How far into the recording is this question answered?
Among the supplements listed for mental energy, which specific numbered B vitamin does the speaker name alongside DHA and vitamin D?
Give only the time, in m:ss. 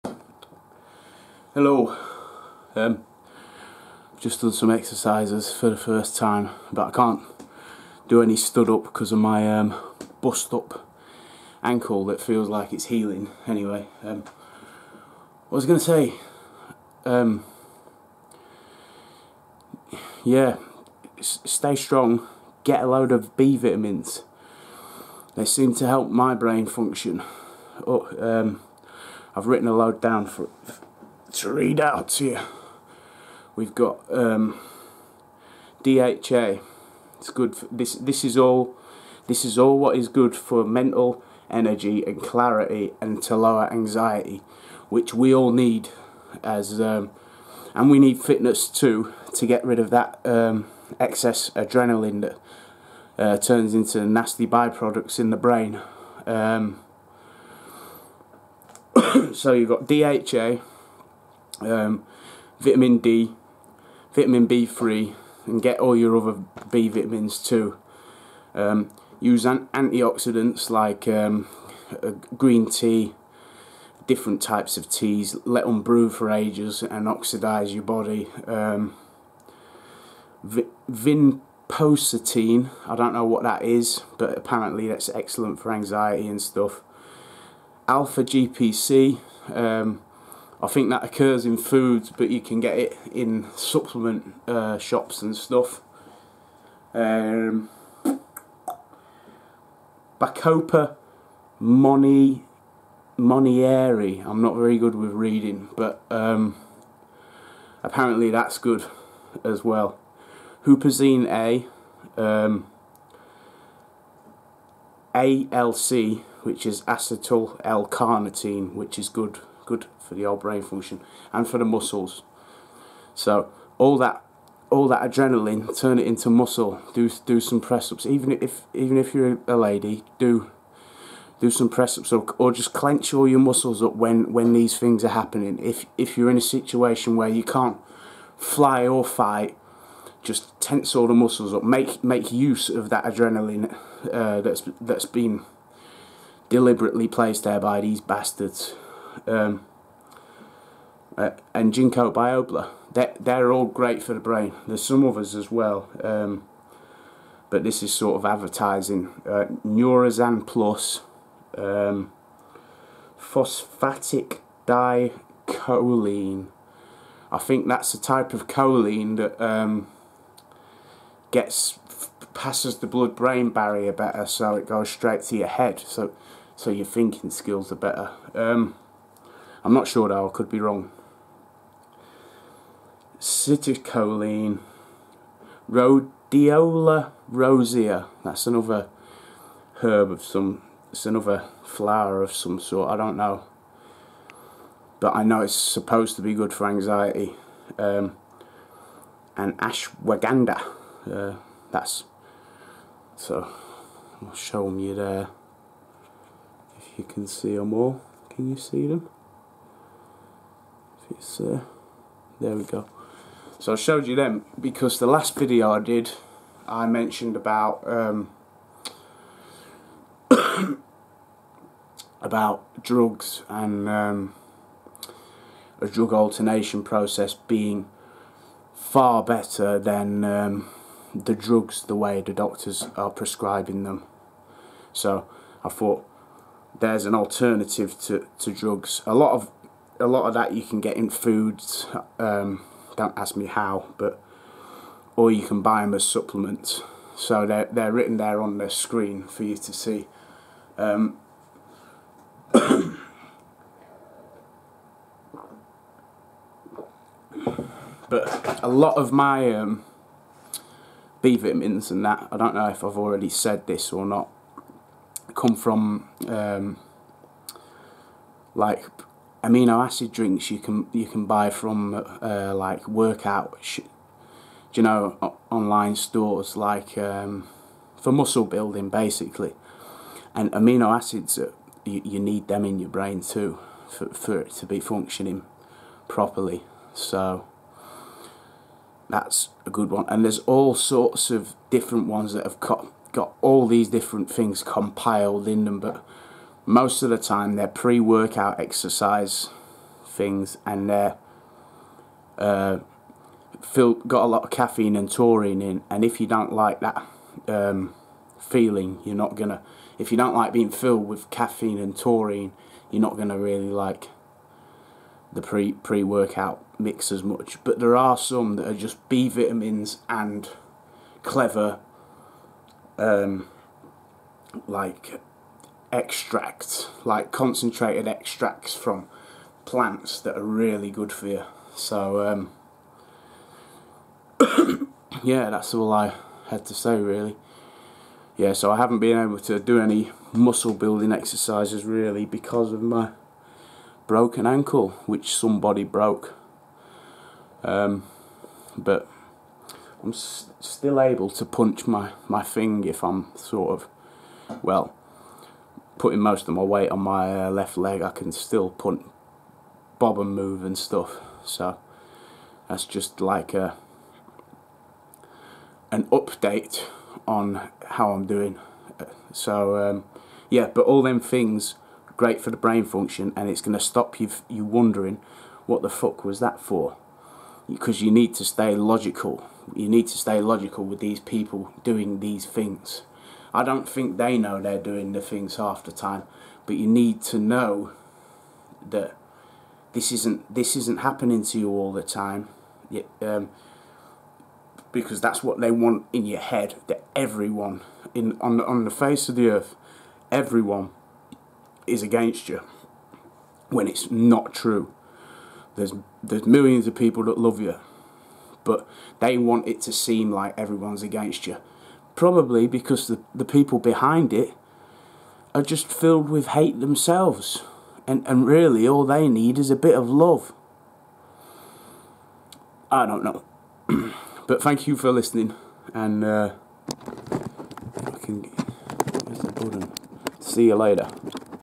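1:04.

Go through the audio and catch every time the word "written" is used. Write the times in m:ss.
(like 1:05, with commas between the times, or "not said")
0:29, 4:07.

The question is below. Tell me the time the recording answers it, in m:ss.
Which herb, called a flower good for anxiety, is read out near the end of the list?
3:05.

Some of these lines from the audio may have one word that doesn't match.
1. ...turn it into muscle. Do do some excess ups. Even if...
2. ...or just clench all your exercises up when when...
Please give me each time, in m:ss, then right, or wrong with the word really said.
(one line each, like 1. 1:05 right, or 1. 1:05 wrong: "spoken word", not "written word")
1. 2:05 wrong: "press", not "excess"
2. 2:12 wrong: "muscles", not "exercises".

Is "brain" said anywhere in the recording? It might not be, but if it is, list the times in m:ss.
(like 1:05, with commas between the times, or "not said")
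0:26, 0:55, 2:00, 2:34, 2:52, 4:42, 6:12.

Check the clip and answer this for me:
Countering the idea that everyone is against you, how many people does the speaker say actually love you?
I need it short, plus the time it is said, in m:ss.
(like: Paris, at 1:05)
Millions, at 6:46.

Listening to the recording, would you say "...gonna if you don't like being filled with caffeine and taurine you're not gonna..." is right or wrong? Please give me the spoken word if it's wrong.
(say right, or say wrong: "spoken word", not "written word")
right.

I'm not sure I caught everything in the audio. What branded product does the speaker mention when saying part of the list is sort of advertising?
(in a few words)
Neurazan Plus.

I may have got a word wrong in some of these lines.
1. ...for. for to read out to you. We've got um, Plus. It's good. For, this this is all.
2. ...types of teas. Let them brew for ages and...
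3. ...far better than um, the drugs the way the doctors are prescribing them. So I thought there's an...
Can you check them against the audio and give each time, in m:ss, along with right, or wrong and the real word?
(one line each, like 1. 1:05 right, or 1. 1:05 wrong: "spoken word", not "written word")
1. 0:30 wrong: "DHA", not "Plus"
2. 1:14 right
3. 3:48 right.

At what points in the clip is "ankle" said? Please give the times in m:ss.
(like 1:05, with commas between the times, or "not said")
0:11, 5:44.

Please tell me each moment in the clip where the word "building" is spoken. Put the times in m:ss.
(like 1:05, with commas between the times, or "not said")
4:38, 5:40.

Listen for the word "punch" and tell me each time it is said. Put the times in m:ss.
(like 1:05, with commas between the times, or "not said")
5:51.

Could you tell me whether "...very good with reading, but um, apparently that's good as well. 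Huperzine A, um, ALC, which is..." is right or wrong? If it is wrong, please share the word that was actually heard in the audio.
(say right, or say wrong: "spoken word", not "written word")
right.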